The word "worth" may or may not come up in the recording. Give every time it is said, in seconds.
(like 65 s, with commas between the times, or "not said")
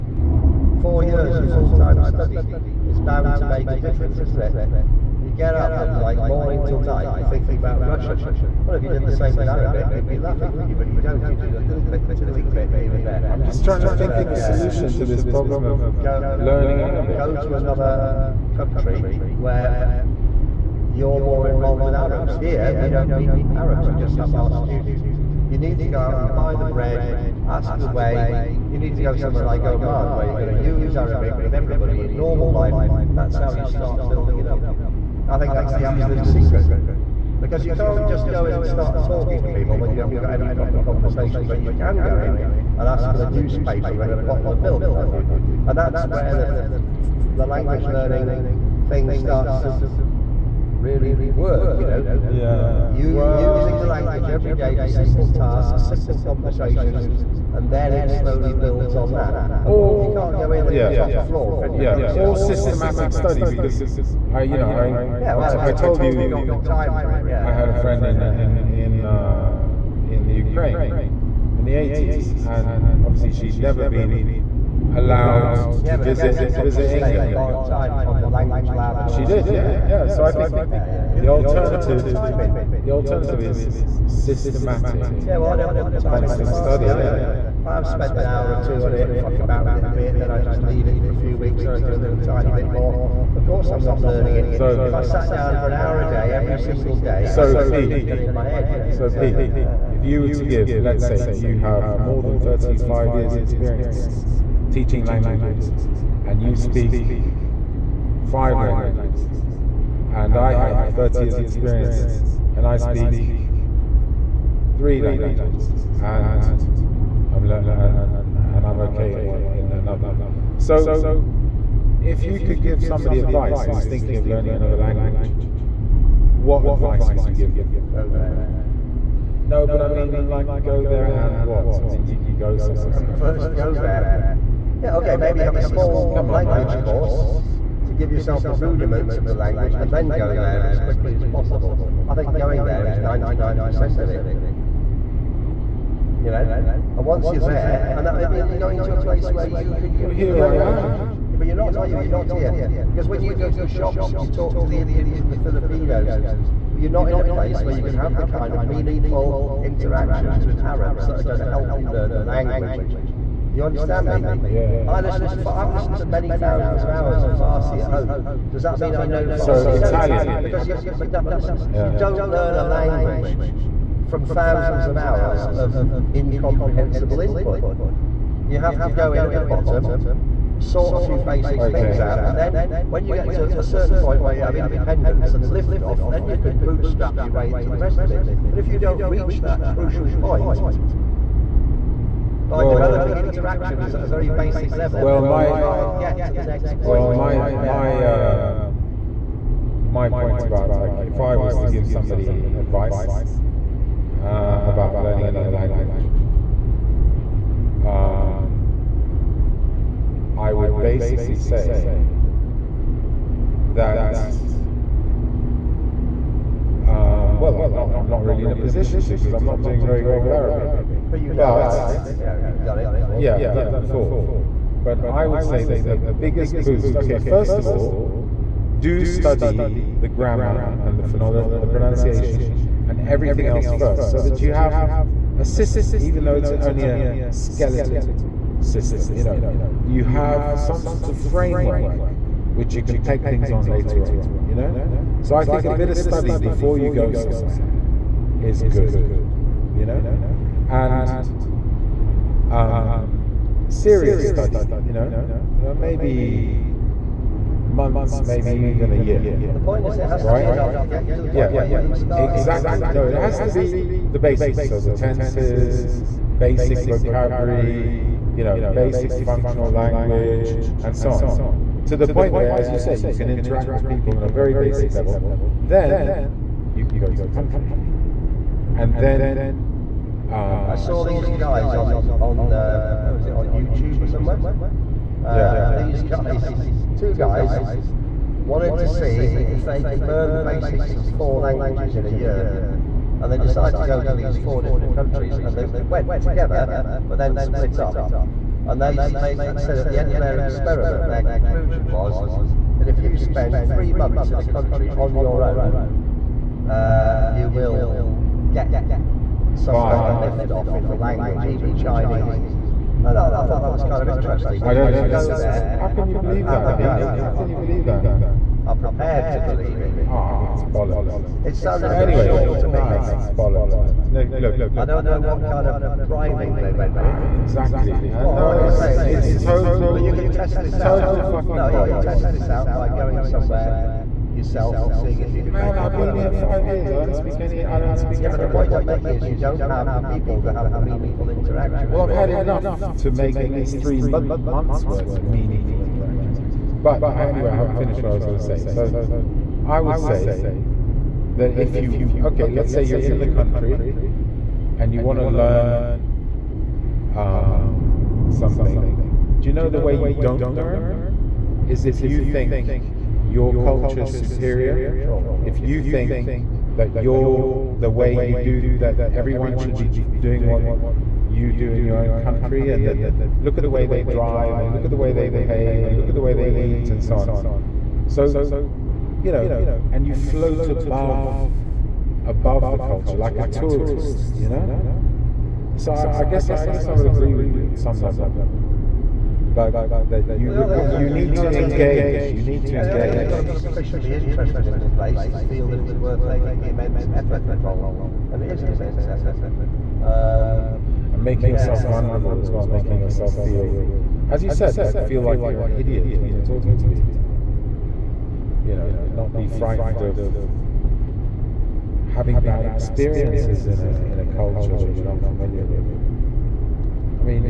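344 s, 395 s.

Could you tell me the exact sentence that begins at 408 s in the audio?
You know, not be frightened of having bad experiences in a in a culture that you're not familiar with.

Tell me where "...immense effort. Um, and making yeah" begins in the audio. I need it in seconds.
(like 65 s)
398 s.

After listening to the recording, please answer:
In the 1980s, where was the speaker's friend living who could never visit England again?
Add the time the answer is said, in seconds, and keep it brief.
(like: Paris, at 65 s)
Ukraine, at 70 s.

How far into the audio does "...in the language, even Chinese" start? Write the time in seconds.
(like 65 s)
310 s.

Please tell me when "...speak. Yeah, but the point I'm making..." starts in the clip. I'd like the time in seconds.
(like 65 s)
337 s.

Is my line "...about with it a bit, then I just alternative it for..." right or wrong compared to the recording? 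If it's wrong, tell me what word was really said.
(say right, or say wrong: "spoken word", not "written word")
wrong: "leave", not "alternative".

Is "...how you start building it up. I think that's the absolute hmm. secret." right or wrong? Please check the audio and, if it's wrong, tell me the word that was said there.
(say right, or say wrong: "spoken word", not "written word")
right.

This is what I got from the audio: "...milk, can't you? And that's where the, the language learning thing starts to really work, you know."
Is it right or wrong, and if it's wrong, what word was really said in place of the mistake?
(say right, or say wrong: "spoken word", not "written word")
right.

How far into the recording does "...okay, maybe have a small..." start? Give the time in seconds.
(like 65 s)
134 s.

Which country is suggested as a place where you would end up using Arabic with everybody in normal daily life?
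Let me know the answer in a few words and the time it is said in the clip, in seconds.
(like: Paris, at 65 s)
Oman, at 29 s.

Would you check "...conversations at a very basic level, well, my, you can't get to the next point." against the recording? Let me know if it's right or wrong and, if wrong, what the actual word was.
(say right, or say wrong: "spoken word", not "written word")
wrong: "interactions", not "conversations".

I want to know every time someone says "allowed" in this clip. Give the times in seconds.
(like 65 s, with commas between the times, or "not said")
74 s.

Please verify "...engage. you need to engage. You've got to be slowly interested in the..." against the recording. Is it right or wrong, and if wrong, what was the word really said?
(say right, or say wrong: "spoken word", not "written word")
wrong: "sufficiently", not "slowly".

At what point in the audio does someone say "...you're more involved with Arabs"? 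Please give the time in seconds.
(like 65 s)
20 s.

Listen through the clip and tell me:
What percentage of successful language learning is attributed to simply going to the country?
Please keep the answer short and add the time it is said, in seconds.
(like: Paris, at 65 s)
99%, at 142 s.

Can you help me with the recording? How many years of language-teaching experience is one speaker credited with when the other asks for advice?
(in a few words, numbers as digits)
35.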